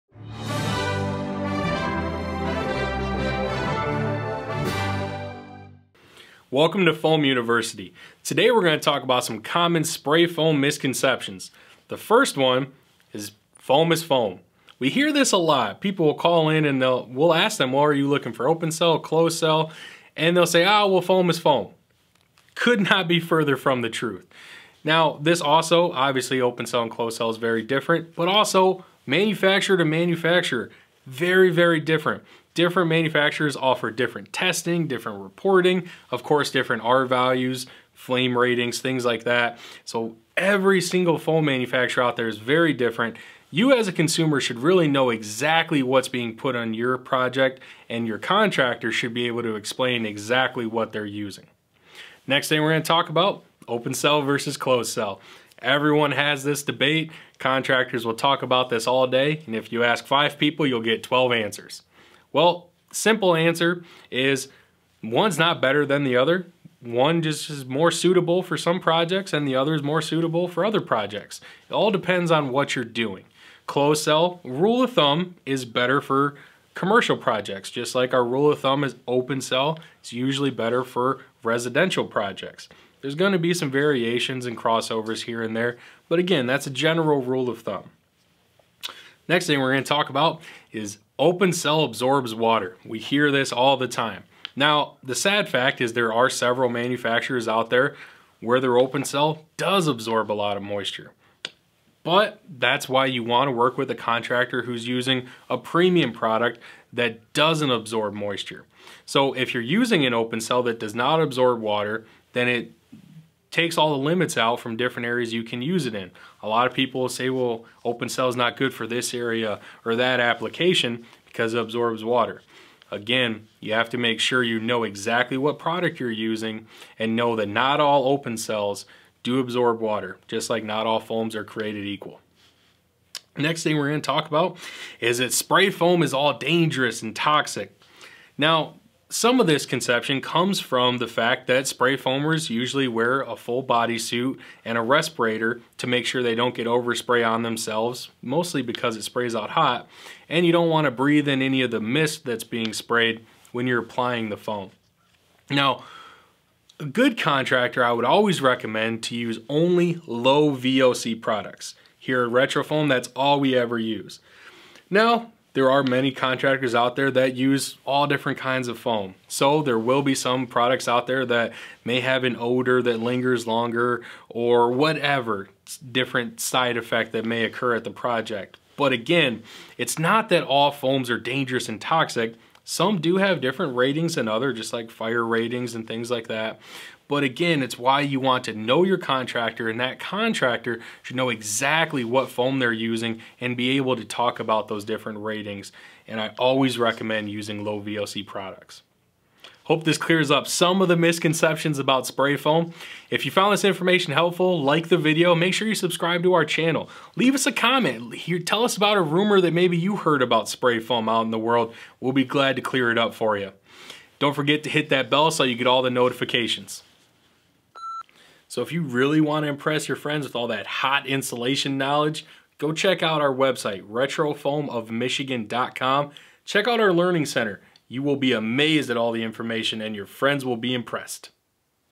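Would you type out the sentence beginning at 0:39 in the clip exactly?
So every single foam manufacturer out there is very different.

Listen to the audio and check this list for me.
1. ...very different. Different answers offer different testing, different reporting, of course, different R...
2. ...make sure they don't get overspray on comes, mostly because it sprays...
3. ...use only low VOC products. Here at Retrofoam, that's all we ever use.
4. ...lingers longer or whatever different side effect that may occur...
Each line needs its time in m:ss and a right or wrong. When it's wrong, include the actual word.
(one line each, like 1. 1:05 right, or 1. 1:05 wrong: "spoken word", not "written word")
1. 0:31 wrong: "manufacturers", not "answers"
2. 2:25 wrong: "themselves", not "comes"
3. 2:39 right
4. 2:53 right.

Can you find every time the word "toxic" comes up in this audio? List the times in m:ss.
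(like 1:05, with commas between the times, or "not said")
2:17, 3:01.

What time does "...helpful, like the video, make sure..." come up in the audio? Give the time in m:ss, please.
3:24.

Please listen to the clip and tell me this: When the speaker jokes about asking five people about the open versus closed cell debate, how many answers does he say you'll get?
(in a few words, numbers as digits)
12.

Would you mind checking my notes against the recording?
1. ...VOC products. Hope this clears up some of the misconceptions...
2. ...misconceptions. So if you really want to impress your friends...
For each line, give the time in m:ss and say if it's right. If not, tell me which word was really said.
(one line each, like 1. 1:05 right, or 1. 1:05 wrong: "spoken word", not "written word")
1. 3:17 right
2. 3:35 wrong: "notifications", not "misconceptions".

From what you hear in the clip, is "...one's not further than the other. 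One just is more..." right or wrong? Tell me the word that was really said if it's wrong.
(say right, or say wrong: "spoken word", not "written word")
wrong: "better", not "further".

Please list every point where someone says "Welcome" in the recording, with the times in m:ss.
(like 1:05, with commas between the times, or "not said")
0:06.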